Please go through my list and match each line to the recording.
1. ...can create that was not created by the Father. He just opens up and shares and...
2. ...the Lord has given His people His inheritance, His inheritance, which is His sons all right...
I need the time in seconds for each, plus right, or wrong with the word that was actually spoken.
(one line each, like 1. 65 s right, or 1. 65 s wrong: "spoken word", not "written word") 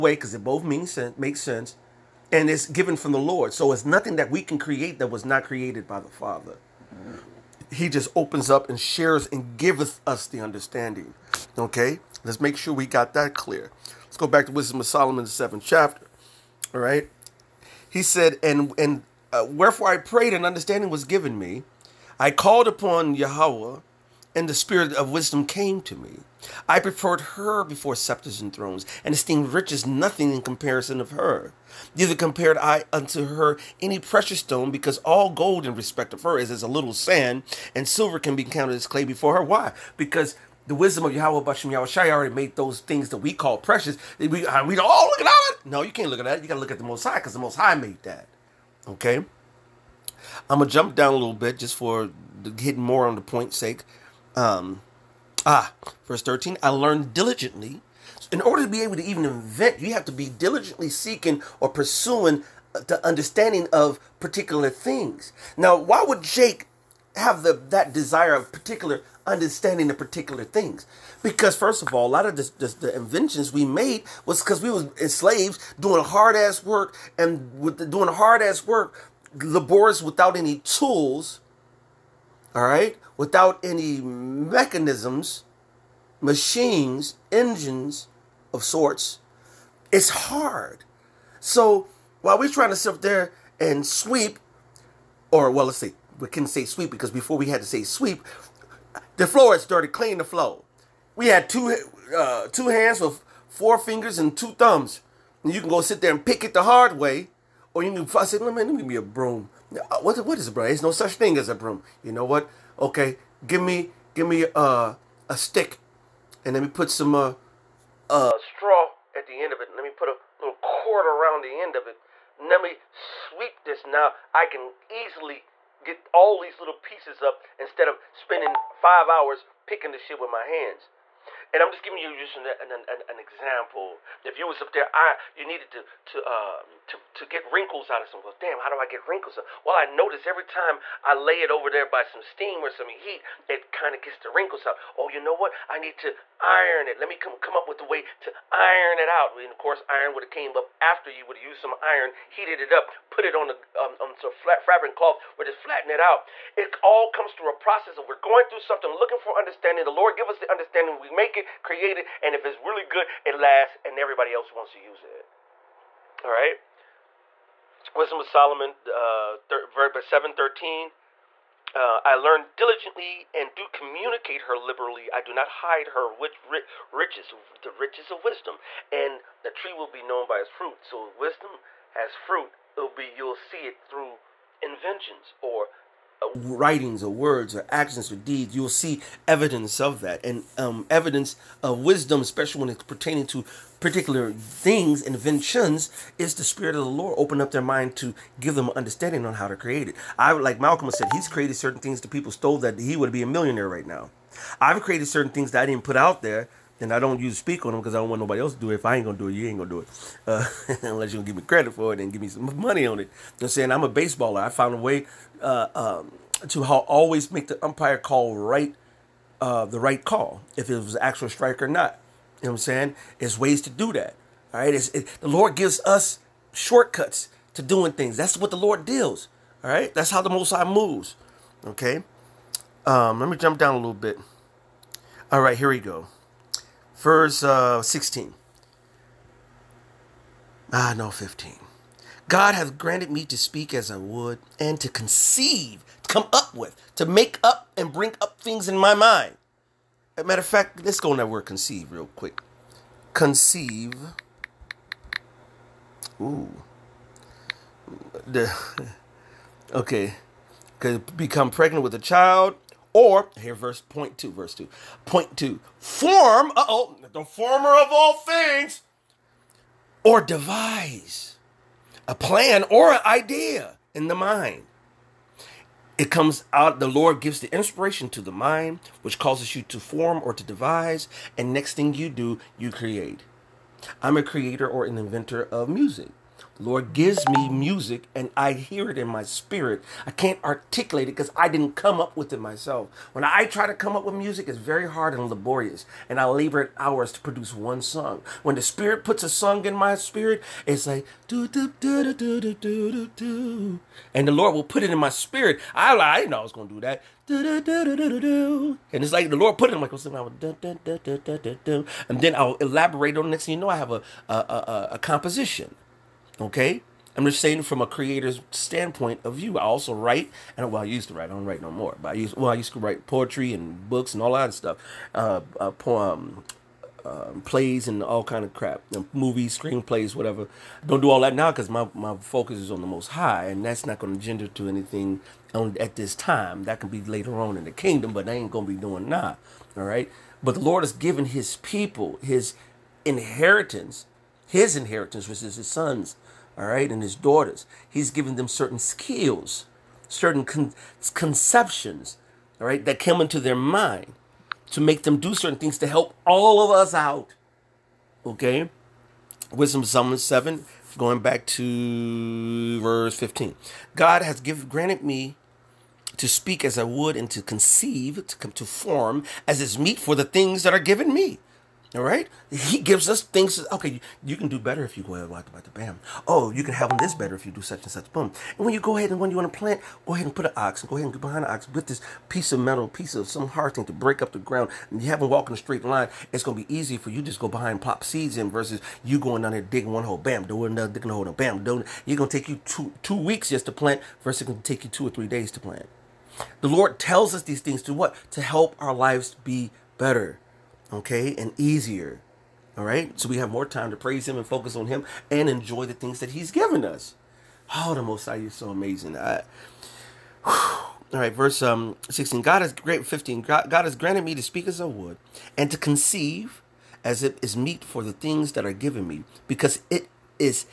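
1. 4 s right
2. 340 s right.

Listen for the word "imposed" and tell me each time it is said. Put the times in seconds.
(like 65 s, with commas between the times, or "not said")
not said.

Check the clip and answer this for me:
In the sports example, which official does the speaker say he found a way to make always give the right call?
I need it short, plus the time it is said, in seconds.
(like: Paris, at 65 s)
the umpire, at 217 s.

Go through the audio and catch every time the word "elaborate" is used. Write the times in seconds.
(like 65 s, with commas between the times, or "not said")
312 s.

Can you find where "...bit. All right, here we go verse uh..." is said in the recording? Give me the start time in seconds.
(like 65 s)
233 s.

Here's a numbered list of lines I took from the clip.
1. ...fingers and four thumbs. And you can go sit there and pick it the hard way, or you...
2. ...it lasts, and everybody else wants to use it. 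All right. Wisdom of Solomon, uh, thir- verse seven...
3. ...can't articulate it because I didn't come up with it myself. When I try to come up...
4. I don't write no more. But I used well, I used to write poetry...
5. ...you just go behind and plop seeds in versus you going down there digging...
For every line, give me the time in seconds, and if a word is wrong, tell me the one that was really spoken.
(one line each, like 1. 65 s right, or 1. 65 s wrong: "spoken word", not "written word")
1. 103 s wrong: "two", not "four"
2. 163 s right
3. 290 s right
4. 321 s right
5. 387 s right.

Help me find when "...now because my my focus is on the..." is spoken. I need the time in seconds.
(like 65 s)
331 s.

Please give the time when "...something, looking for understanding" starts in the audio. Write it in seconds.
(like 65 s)
158 s.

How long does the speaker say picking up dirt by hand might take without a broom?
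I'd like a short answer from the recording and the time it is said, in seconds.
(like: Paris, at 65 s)
five hours, at 128 s.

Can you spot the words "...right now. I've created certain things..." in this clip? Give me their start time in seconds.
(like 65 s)
203 s.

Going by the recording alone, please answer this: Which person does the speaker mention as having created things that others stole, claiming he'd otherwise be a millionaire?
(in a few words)
Malcolm.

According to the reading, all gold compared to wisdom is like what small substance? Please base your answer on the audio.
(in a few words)
a little sand.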